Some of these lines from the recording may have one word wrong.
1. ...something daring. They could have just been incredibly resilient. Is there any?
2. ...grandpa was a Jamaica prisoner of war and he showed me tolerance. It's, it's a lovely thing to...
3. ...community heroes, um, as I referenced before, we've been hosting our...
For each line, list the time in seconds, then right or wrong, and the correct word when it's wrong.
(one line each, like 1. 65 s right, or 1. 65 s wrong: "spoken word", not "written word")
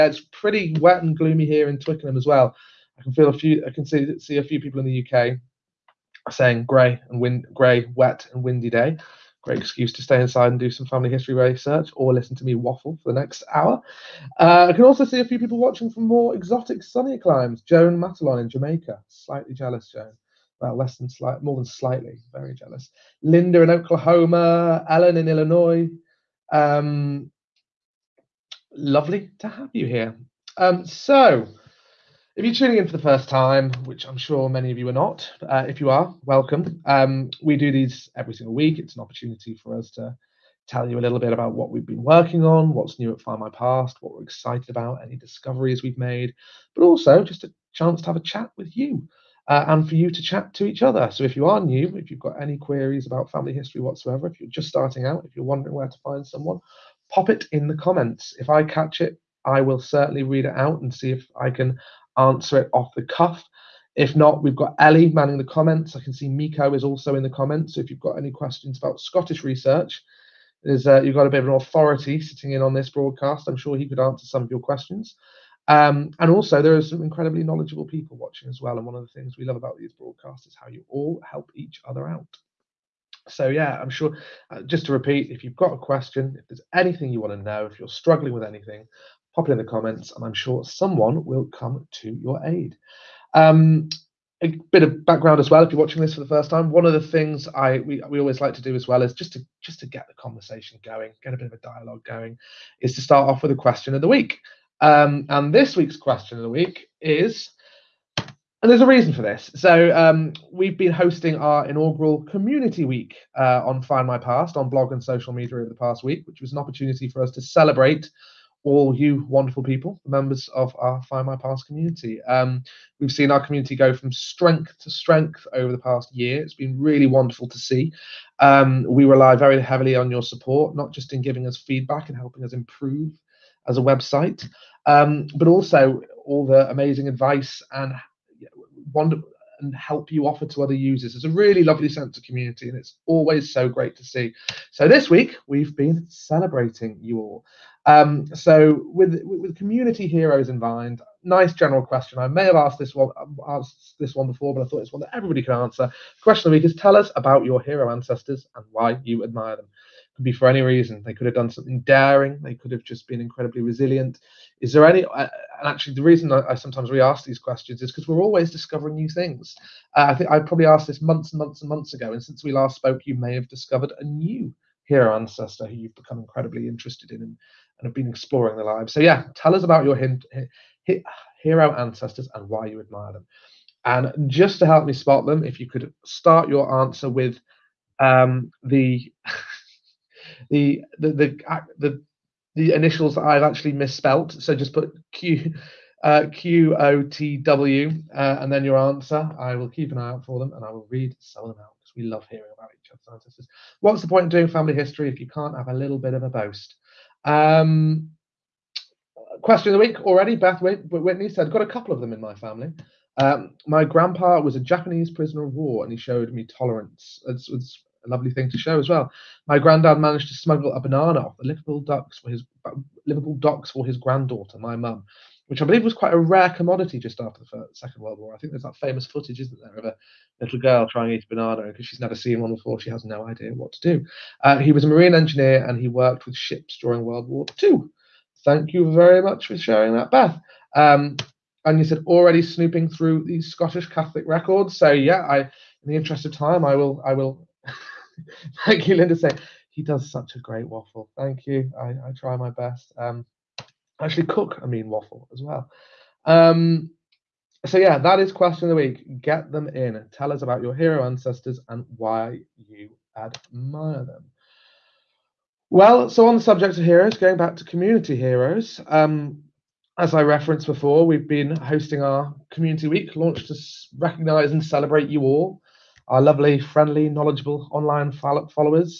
1. 161 s right
2. 213 s wrong: "Japanese", not "Jamaica"
3. 267 s right.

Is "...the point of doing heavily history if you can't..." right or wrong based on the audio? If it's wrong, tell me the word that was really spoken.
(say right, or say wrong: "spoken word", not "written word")
wrong: "family", not "heavily".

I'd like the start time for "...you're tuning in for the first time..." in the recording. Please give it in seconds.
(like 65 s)
32 s.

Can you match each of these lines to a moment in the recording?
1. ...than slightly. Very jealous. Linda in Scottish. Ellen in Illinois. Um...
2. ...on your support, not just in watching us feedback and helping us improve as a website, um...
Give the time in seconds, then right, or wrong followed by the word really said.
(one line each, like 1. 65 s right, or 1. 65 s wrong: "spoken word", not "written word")
1. 21 s wrong: "Oklahoma", not "Scottish"
2. 129 s wrong: "giving", not "watching".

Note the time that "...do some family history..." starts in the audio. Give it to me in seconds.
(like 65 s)
10 s.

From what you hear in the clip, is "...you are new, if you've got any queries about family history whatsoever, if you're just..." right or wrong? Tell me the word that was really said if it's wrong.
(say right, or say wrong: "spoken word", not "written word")
right.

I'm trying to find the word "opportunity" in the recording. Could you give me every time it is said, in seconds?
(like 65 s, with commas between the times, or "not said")
39 s, 116 s.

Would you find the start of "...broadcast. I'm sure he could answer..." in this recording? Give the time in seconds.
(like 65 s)
72 s.